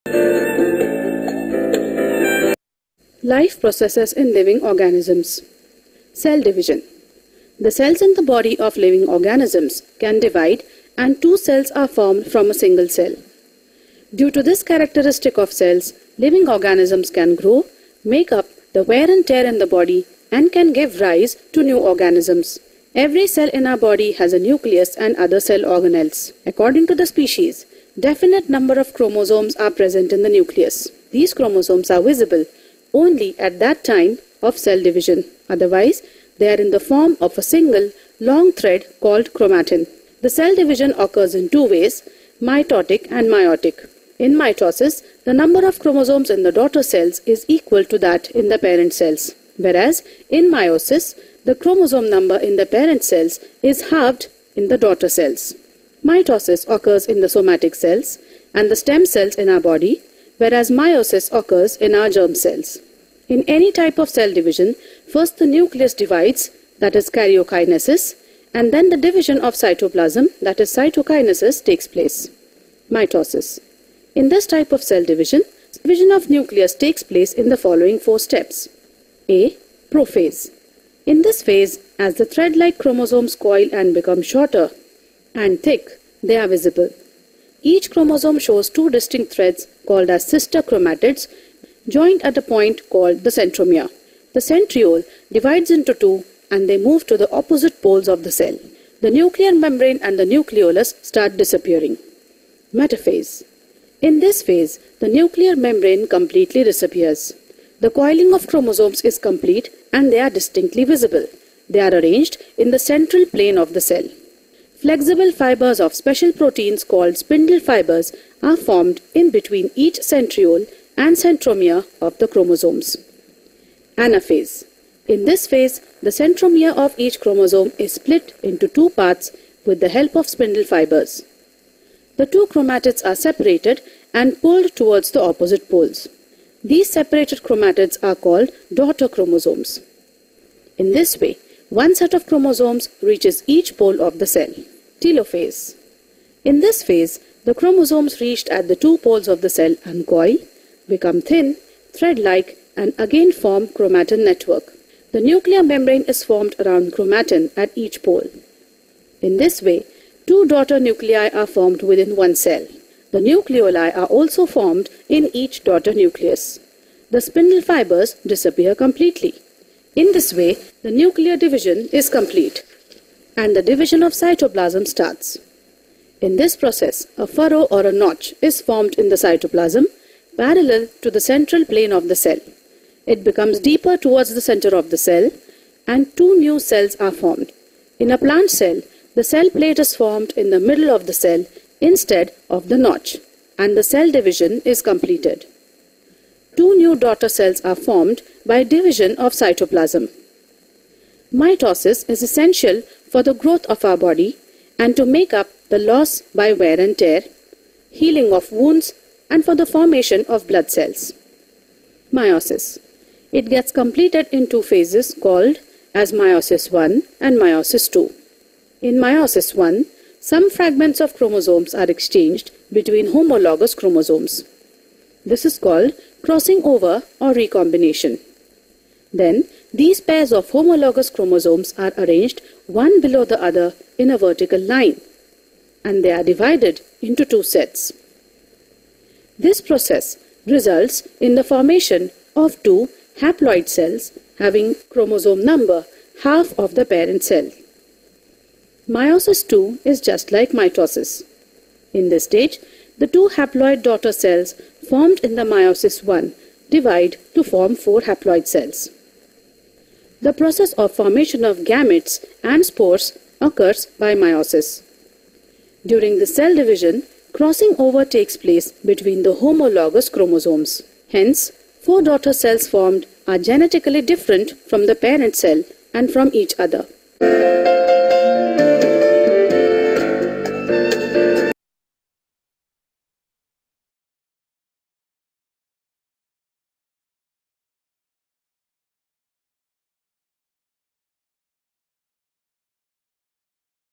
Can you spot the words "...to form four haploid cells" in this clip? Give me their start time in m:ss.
4:17.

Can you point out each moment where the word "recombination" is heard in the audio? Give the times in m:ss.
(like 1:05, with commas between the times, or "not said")
3:47.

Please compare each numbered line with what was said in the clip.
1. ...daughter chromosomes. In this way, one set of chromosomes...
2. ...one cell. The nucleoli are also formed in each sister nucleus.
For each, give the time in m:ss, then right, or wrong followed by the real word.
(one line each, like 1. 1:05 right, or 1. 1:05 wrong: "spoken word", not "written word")
1. 2:18 right
2. 2:42 wrong: "daughter", not "sister".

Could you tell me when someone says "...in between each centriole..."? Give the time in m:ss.
1:59.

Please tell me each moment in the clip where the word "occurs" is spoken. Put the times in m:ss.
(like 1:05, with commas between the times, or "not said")
0:40, 0:56, 1:01, 4:23.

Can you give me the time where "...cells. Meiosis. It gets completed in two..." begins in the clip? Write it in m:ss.
3:30.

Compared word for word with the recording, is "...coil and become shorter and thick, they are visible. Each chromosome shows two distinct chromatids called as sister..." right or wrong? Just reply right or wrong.
wrong.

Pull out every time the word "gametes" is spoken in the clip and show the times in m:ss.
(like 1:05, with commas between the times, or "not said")
4:21.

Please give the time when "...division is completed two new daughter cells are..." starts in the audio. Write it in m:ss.
3:14.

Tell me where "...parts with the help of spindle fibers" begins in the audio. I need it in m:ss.
2:08.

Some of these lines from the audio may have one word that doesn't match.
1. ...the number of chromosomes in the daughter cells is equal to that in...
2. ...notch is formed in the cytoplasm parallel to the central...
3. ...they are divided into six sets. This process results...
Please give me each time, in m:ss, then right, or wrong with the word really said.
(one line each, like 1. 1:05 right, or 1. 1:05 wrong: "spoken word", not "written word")
1. 0:45 right
2. 2:57 right
3. 3:56 wrong: "two", not "six".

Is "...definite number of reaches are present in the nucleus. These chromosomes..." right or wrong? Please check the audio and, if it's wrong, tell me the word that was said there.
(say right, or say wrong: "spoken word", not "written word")
wrong: "chromosomes", not "reaches".